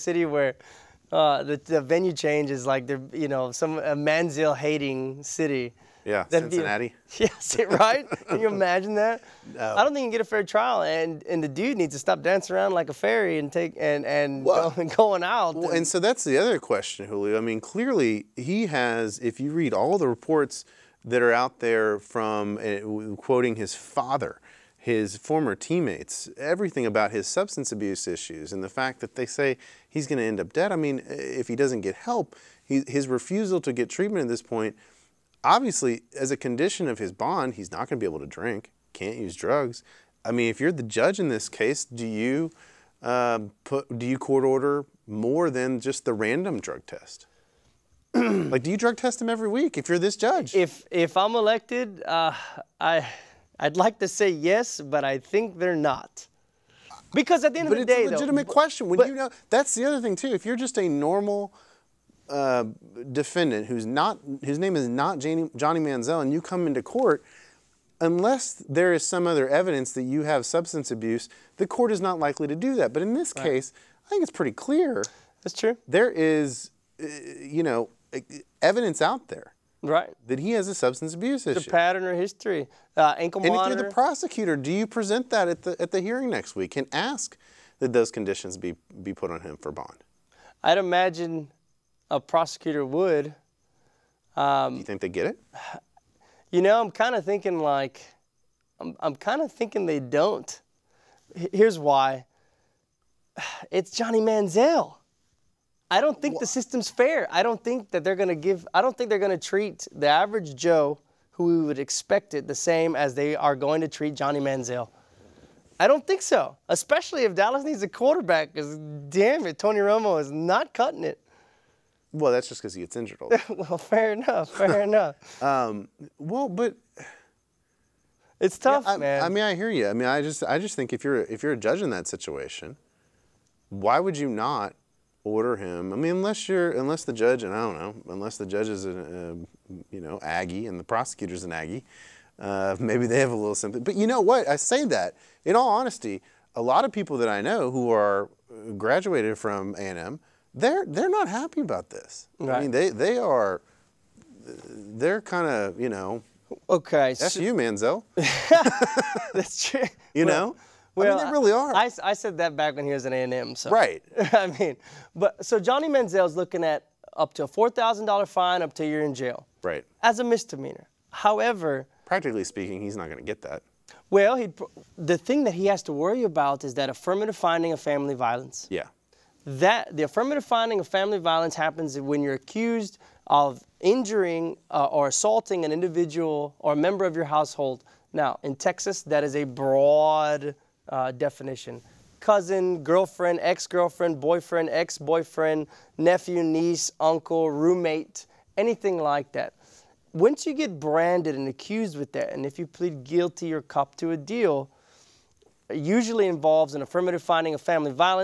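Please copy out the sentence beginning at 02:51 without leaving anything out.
However, practically speaking, he's not going to get that.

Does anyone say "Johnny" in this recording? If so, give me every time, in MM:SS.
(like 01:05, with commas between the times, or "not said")
01:05, 01:43, 01:54, 02:45.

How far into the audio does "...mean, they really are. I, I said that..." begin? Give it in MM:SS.
02:41.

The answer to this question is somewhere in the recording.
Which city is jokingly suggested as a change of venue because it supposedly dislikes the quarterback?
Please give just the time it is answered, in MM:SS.
00:06.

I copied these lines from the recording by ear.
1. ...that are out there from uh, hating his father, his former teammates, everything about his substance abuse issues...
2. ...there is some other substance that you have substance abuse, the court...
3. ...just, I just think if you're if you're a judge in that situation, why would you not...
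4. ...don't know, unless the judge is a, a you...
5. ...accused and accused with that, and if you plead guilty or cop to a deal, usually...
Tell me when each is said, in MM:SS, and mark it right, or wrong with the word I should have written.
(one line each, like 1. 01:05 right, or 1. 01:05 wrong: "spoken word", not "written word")
1. 00:21 wrong: "quoting", not "hating"
2. 01:08 wrong: "evidence", not "substance"
3. 02:10 right
4. 02:17 right
5. 03:20 wrong: "branded", not "accused".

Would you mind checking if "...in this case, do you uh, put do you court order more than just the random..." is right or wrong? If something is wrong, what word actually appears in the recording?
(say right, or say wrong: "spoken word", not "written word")
right.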